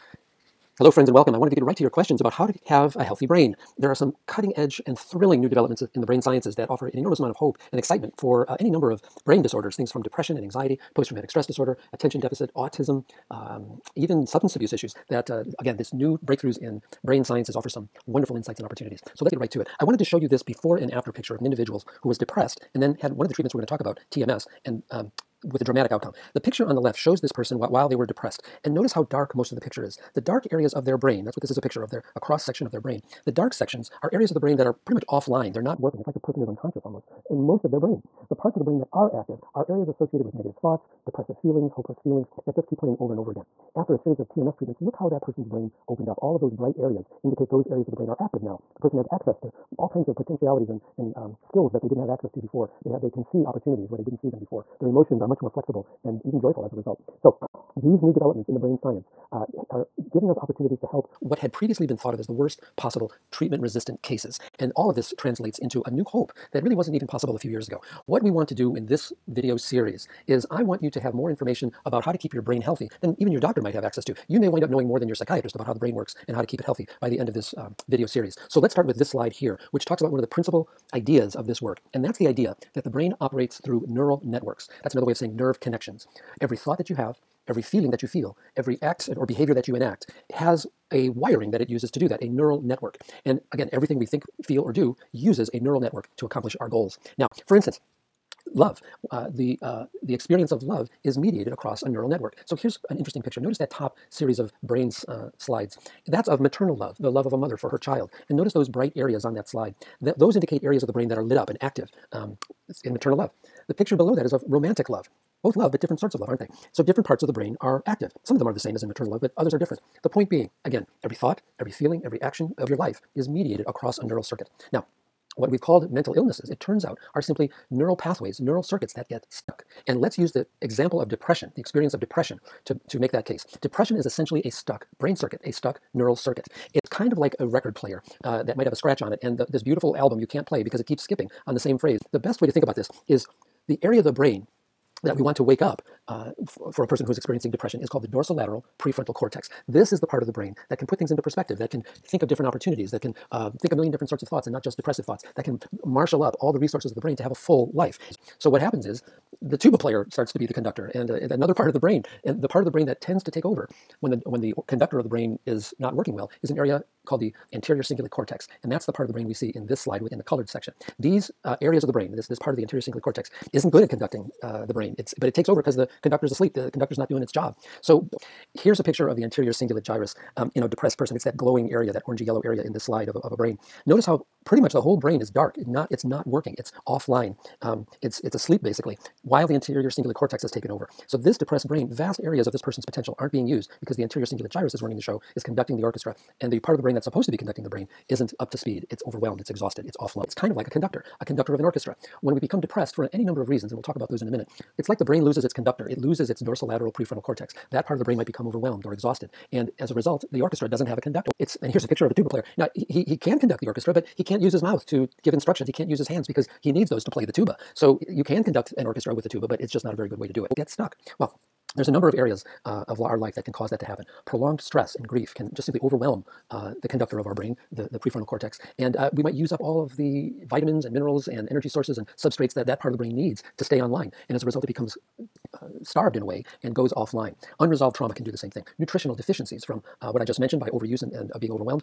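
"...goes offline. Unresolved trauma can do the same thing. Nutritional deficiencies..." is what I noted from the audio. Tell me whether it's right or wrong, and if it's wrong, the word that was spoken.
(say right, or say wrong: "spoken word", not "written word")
right.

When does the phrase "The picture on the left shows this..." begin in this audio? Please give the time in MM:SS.
00:26.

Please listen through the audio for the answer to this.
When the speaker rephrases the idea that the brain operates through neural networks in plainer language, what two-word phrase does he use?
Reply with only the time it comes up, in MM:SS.
01:25.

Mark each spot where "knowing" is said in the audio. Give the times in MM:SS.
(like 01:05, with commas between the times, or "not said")
01:14.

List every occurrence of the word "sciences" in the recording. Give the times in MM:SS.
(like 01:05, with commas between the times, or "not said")
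00:06, 00:17, 00:58.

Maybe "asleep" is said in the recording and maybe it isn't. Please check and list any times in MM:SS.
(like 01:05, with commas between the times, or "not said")
02:56, 03:08.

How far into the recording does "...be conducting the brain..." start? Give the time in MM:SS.
03:17.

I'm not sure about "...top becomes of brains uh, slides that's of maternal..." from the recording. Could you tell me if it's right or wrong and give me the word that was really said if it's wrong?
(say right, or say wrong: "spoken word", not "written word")
wrong: "series", not "becomes".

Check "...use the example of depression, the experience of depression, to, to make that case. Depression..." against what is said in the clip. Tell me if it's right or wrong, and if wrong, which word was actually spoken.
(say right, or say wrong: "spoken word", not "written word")
right.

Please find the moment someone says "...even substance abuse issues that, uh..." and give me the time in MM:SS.
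00:13.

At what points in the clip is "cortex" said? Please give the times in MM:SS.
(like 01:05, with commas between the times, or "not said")
02:29, 02:48, 02:53, 03:10, 03:27, 03:48.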